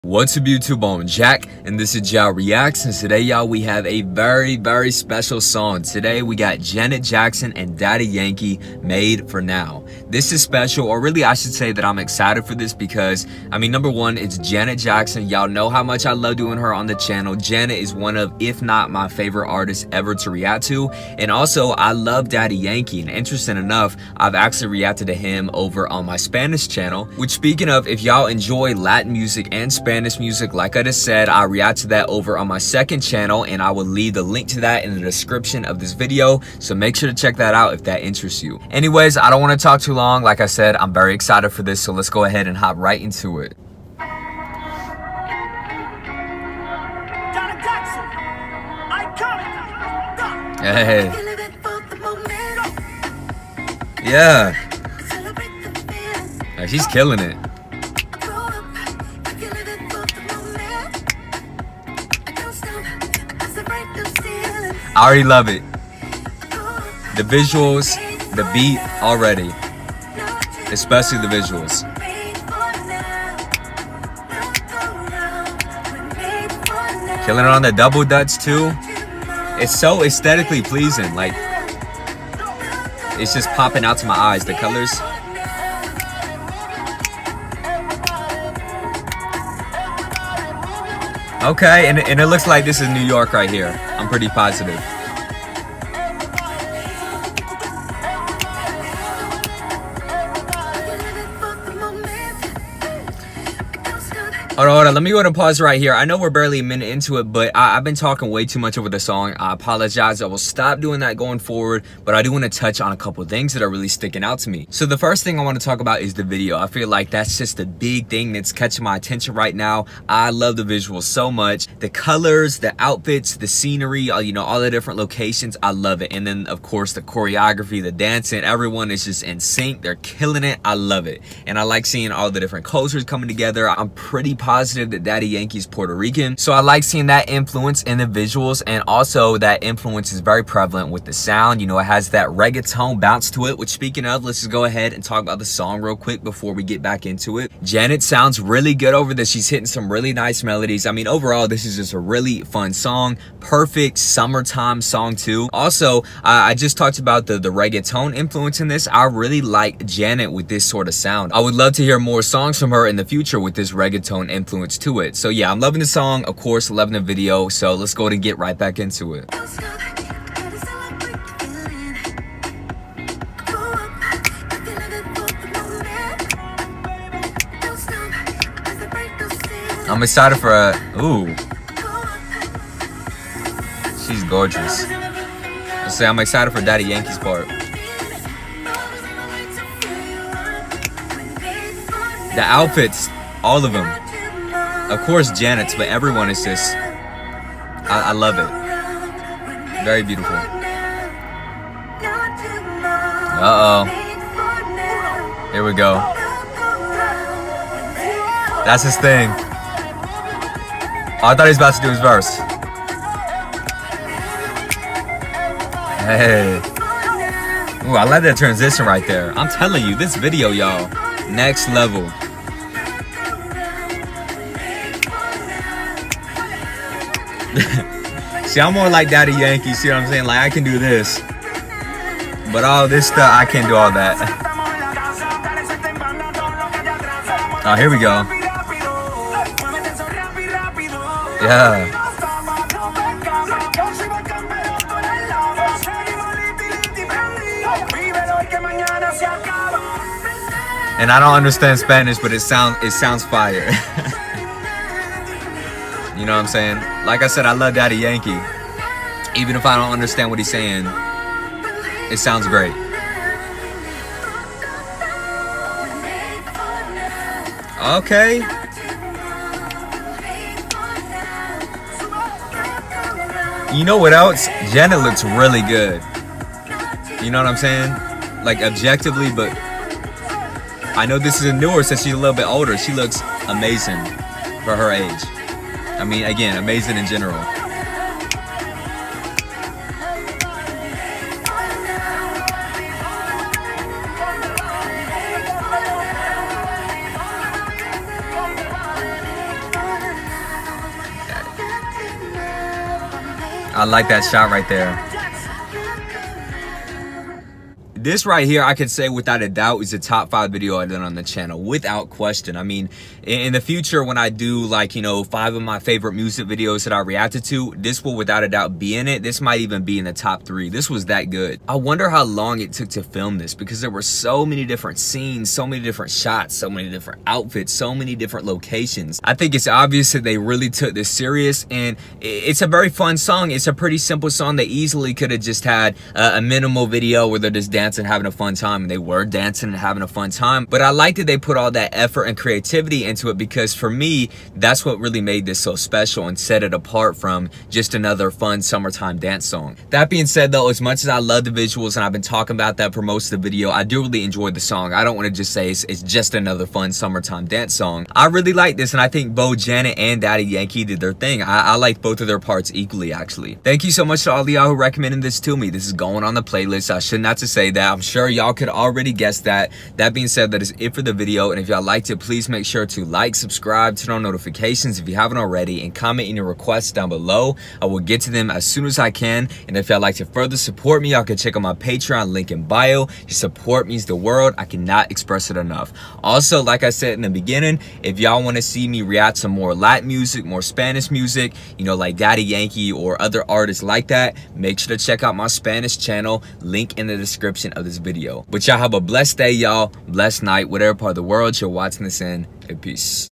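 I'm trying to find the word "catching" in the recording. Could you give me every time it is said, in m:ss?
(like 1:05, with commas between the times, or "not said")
1:58.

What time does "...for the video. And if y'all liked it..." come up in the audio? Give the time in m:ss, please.
6:10.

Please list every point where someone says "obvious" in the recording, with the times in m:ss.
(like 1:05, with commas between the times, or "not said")
5:29.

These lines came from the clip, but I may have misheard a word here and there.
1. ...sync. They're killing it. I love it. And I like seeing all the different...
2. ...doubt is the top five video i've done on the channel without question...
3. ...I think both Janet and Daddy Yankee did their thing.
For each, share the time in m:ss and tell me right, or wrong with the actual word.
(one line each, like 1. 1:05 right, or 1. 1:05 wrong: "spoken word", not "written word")
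1. 2:09 right
2. 5:09 right
3. 5:59 right.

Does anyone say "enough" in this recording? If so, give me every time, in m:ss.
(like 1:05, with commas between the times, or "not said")
0:23, 6:25.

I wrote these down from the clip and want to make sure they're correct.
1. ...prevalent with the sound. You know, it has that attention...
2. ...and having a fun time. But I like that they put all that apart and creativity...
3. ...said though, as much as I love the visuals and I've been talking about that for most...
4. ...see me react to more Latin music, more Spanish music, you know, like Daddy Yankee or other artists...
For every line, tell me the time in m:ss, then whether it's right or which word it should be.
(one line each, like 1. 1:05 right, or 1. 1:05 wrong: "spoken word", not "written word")
1. 2:20 wrong: "reggaeton", not "attention"
2. 5:39 wrong: "effort", not "apart"
3. 5:50 right
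4. 6:28 right.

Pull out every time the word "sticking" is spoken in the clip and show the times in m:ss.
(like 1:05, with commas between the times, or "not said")
1:53.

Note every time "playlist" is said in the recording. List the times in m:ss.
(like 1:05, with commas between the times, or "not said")
6:06.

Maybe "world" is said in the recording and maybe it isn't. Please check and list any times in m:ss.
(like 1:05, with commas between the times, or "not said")
6:24, 6:41.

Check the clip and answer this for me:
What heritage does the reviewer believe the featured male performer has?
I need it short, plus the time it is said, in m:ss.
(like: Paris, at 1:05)
Puerto Rican, at 2:15.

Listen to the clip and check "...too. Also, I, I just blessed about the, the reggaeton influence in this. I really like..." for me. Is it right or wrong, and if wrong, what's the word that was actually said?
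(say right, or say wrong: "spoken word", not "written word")
wrong: "talked", not "blessed".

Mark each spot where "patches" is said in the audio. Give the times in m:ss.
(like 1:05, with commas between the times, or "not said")
not said.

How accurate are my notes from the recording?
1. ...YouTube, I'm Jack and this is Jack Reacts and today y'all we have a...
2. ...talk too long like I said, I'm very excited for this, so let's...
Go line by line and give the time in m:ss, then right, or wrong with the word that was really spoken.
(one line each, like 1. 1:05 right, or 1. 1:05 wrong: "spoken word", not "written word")
1. 0:00 right
2. 0:39 right.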